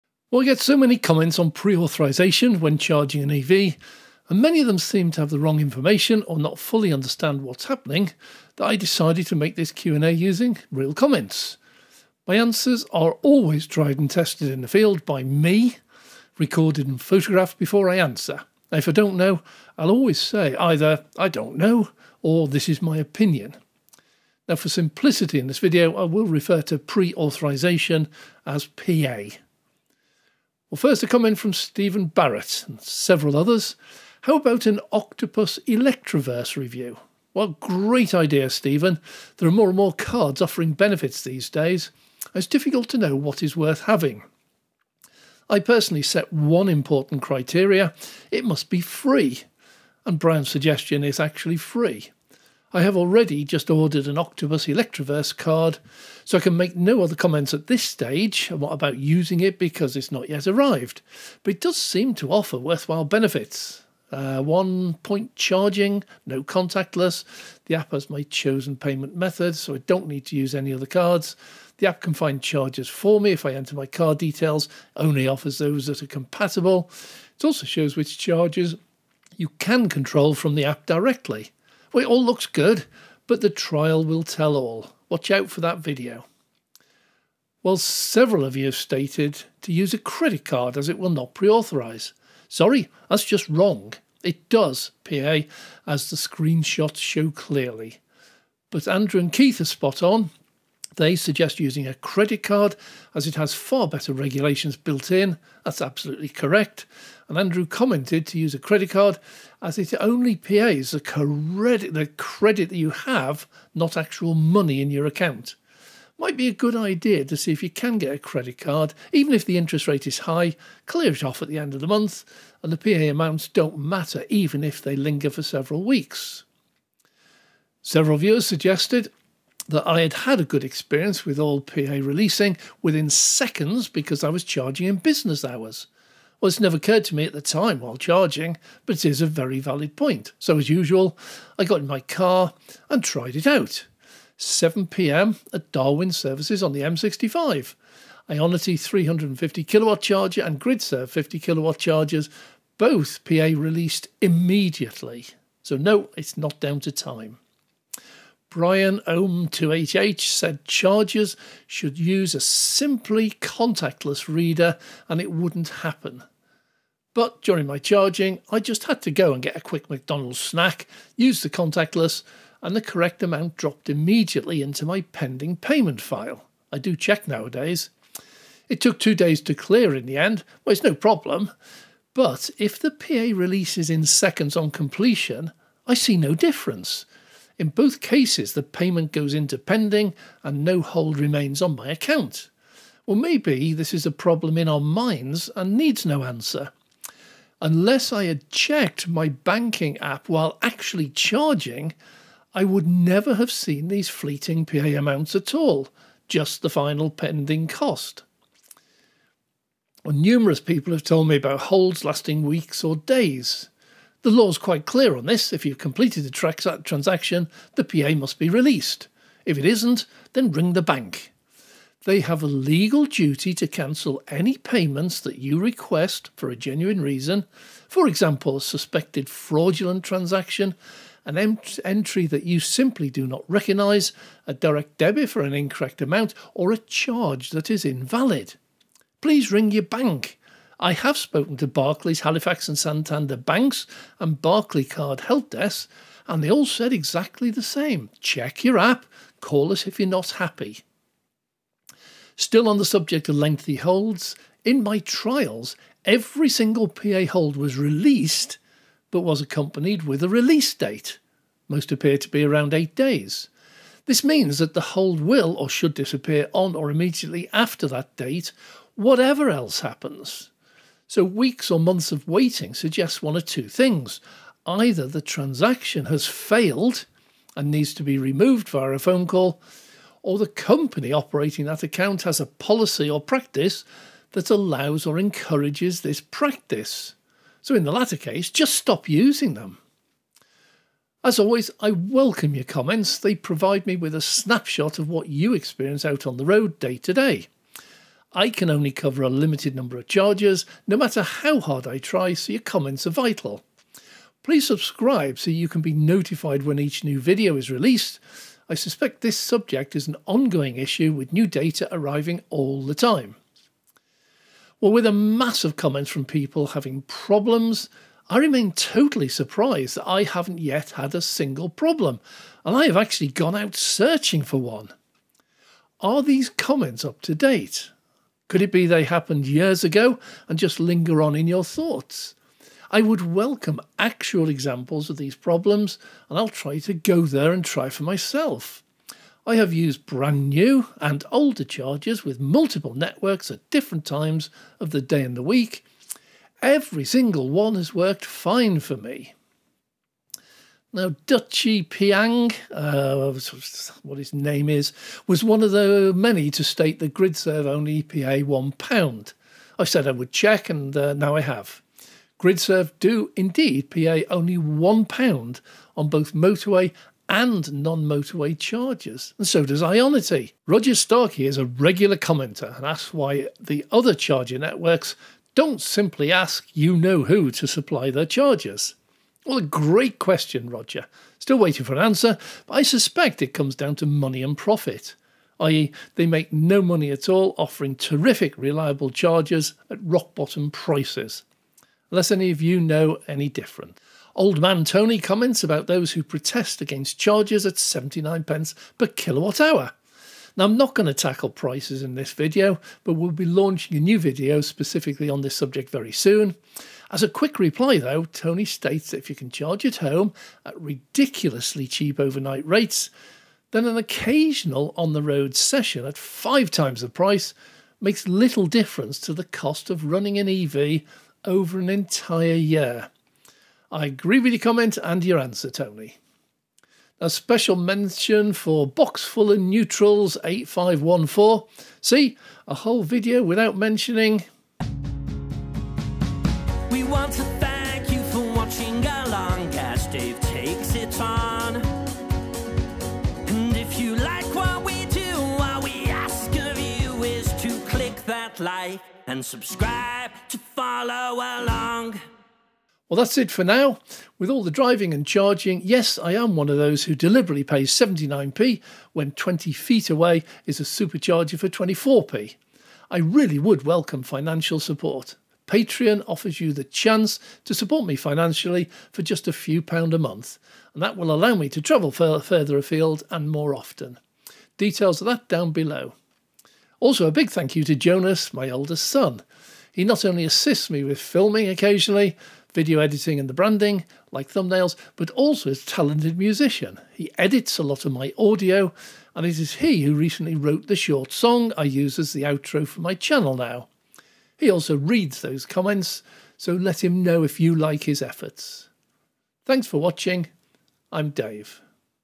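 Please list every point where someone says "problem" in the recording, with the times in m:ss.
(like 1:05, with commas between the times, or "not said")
3:00, 3:14, 5:17, 5:21, 5:35.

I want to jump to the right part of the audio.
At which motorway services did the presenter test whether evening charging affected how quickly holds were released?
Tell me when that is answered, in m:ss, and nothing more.
2:25.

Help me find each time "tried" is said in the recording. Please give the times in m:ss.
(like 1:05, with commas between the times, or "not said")
0:13, 2:23.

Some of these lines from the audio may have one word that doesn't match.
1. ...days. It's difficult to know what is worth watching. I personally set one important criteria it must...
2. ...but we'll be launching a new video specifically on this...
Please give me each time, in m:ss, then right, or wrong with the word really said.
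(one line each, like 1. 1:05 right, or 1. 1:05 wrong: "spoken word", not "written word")
1. 0:41 wrong: "having", not "watching"
2. 6:43 right.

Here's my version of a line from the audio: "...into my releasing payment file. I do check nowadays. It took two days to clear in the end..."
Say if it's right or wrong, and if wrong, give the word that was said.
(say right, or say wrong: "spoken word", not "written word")
wrong: "pending", not "releasing".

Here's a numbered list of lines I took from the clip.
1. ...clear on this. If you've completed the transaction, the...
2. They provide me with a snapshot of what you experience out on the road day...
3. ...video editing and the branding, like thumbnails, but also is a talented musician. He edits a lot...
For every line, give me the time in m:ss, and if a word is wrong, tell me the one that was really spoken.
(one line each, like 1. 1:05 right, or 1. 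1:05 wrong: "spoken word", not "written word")
1. 3:34 right
2. 4:53 right
3. 8:02 right.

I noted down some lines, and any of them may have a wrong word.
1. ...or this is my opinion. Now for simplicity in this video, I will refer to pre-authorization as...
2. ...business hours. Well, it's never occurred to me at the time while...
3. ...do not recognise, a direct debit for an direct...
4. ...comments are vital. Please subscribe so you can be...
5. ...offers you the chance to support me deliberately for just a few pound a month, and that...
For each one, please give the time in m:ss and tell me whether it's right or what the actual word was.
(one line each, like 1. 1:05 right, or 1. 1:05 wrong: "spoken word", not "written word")
1. 0:22 right
2. 2:14 right
3. 3:53 wrong: "incorrect", not "direct"
4. 5:02 right
5. 7:46 wrong: "financially", not "deliberately".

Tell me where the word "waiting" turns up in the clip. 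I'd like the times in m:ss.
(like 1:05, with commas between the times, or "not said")
4:32, 6:21.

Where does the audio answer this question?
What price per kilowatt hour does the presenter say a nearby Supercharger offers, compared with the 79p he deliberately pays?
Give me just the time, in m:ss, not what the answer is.
7:41.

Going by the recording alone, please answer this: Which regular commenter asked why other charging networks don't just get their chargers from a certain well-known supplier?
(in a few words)
Roger Starkey.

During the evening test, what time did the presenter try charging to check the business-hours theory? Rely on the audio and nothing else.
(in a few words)
7 pm.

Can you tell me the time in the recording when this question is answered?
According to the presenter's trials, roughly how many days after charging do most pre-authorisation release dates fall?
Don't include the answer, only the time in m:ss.
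4:22.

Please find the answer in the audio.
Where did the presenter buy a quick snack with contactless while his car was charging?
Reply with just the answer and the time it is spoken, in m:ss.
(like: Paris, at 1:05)
McDonald's, at 2:49.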